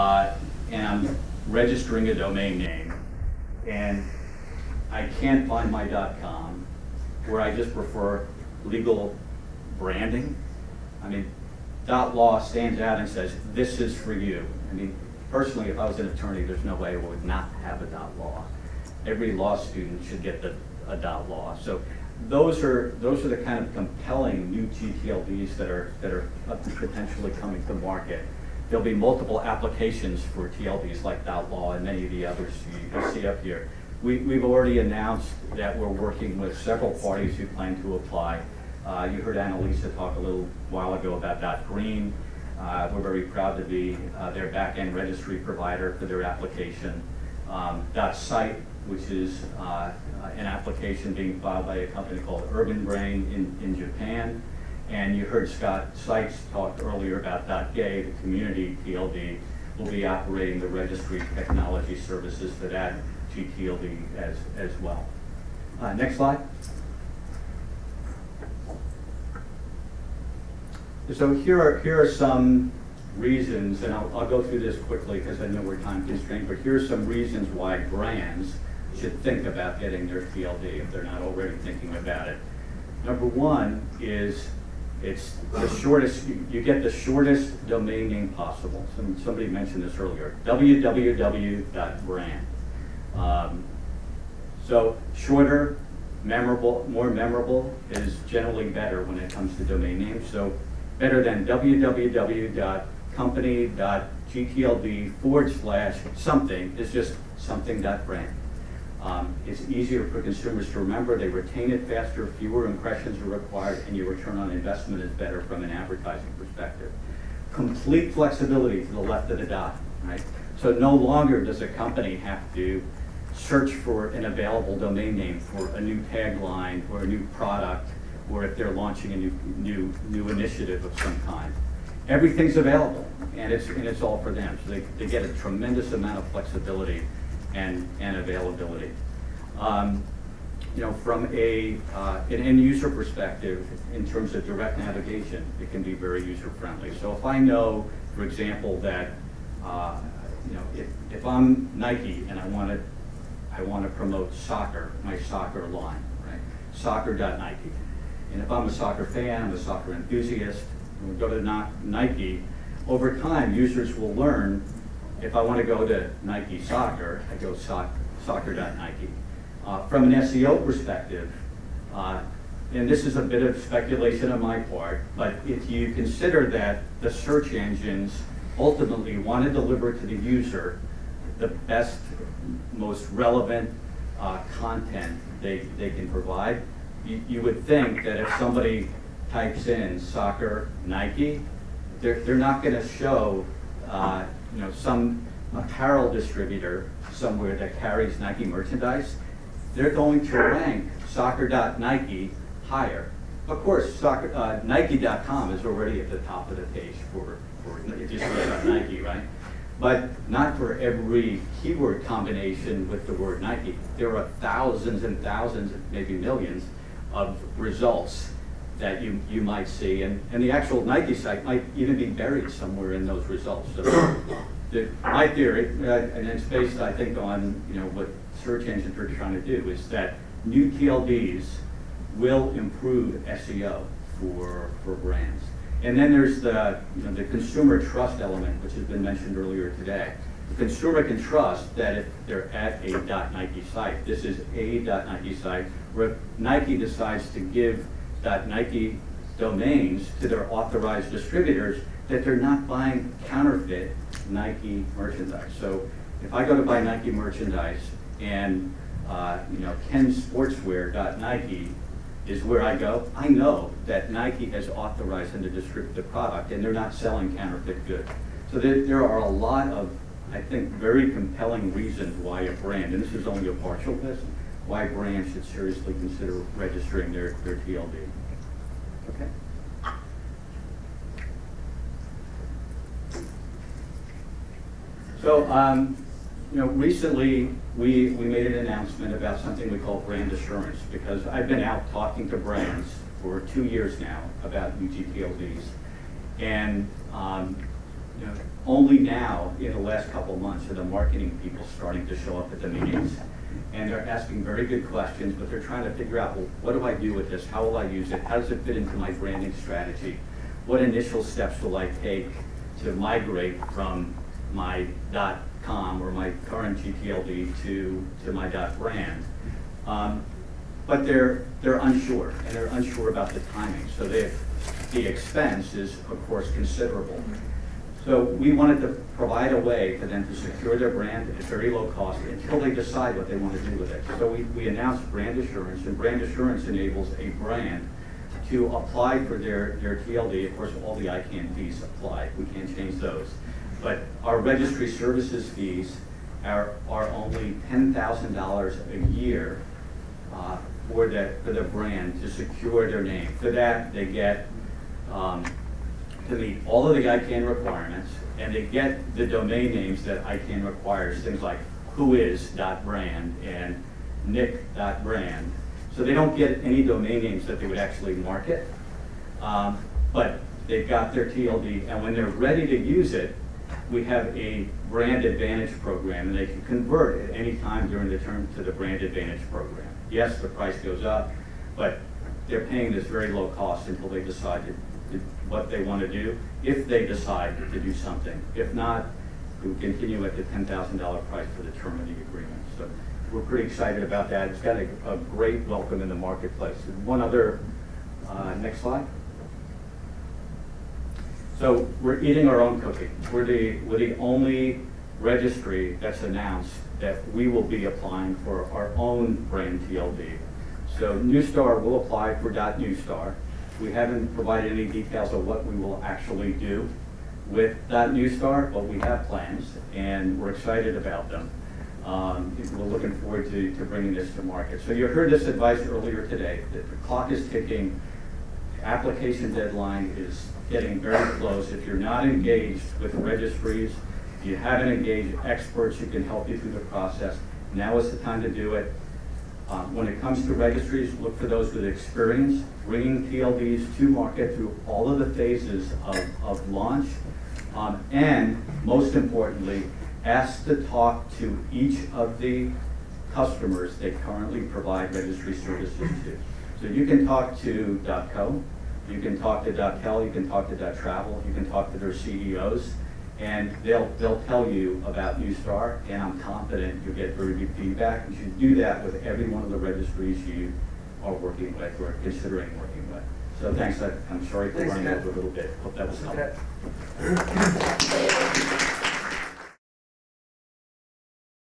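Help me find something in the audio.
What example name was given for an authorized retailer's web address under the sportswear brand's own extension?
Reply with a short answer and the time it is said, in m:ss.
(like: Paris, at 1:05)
kensportswear.nike, at 4:19.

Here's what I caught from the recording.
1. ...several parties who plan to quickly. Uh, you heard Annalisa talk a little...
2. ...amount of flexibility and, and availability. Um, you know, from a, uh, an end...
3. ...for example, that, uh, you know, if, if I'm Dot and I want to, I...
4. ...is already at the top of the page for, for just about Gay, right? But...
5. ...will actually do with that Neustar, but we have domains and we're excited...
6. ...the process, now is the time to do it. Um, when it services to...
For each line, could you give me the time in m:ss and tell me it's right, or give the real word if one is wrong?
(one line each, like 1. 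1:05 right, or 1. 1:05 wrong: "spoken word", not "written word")
1. 0:36 wrong: "apply", not "quickly"
2. 2:15 right
3. 2:28 wrong: "Nike", not "Dot"
4. 3:25 wrong: "Nike", not "Gay"
5. 6:55 wrong: "plans", not "domains"
6. 7:16 wrong: "comes", not "services".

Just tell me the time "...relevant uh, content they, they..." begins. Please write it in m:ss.
3:03.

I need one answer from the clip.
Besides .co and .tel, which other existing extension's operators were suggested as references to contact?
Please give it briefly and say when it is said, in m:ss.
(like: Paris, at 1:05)
.travel, at 7:40.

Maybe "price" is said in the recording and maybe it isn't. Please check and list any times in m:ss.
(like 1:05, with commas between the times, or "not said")
6:20, 6:31.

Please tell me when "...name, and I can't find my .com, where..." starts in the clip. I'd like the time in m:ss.
0:02.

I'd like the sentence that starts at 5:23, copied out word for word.
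So the expense is, of course, considerable.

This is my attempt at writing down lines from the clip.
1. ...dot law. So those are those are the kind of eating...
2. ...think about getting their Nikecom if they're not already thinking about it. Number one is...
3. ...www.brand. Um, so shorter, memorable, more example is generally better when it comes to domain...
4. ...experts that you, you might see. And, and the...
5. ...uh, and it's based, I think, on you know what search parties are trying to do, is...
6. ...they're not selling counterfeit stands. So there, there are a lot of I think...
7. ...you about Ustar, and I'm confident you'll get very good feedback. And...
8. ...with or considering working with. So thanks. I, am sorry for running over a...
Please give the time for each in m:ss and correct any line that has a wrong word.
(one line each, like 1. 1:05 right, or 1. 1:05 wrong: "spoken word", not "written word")
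1. 0:20 wrong: "compelling", not "eating"
2. 1:19 wrong: "TLD", not "Nikecom"
3. 1:30 wrong: "memorable", not "example"
4. 3:37 wrong: "results", not "experts"
5. 3:45 wrong: "engines", not "parties"
6. 4:26 wrong: "goods", not "stands"
7. 7:44 right
8. 7:51 right.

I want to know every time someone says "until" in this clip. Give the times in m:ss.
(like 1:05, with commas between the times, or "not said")
5:32, 6:23.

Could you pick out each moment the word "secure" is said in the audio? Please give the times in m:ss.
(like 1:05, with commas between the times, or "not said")
5:30, 5:52.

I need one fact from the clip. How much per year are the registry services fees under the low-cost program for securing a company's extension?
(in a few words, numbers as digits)
$10,000.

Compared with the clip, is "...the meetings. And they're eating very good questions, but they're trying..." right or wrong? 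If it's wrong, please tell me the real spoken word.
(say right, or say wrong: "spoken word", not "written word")
wrong: "asking", not "eating".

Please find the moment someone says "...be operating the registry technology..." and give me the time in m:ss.
0:59.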